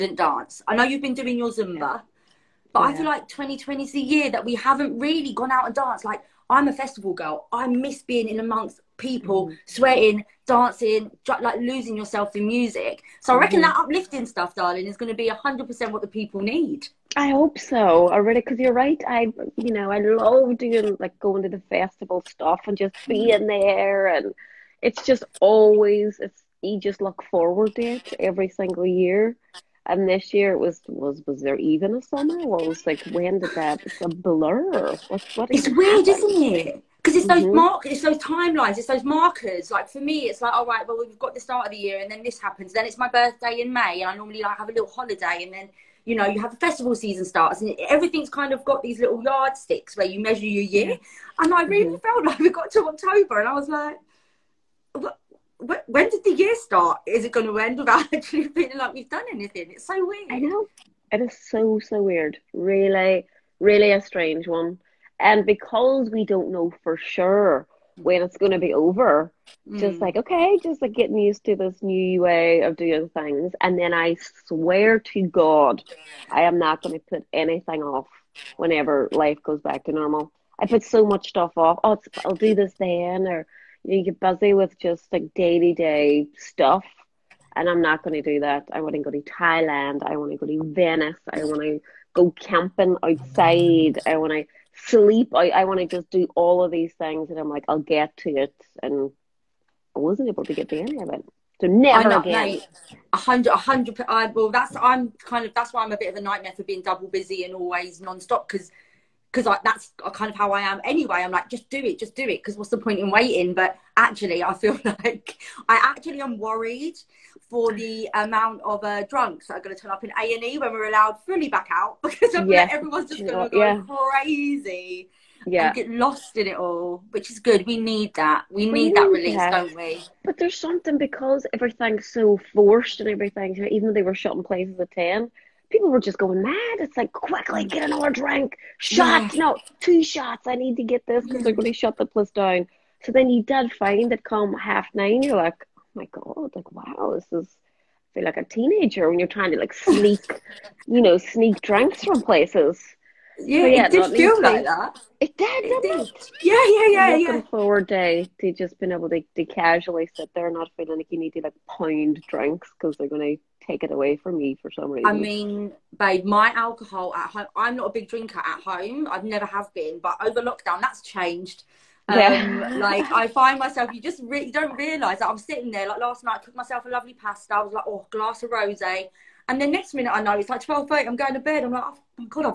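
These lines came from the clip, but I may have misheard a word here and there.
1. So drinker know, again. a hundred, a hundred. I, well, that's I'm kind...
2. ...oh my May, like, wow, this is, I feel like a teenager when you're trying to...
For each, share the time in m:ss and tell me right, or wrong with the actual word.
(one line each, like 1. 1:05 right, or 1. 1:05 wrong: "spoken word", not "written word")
1. 1:41 wrong: "never", not "drinker"
2. 2:25 wrong: "God", not "May".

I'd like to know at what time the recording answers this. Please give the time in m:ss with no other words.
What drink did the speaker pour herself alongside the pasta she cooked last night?
2:58.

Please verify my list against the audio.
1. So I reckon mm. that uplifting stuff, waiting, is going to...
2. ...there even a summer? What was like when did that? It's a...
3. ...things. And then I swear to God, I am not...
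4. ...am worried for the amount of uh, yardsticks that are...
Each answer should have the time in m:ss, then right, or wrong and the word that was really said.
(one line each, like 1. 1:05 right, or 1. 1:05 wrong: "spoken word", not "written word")
1. 0:13 wrong: "darling", not "waiting"
2. 0:31 right
3. 1:13 right
4. 1:56 wrong: "drunks", not "yardsticks".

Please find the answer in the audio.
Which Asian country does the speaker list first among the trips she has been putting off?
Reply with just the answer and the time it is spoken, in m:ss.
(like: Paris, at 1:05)
Thailand, at 1:29.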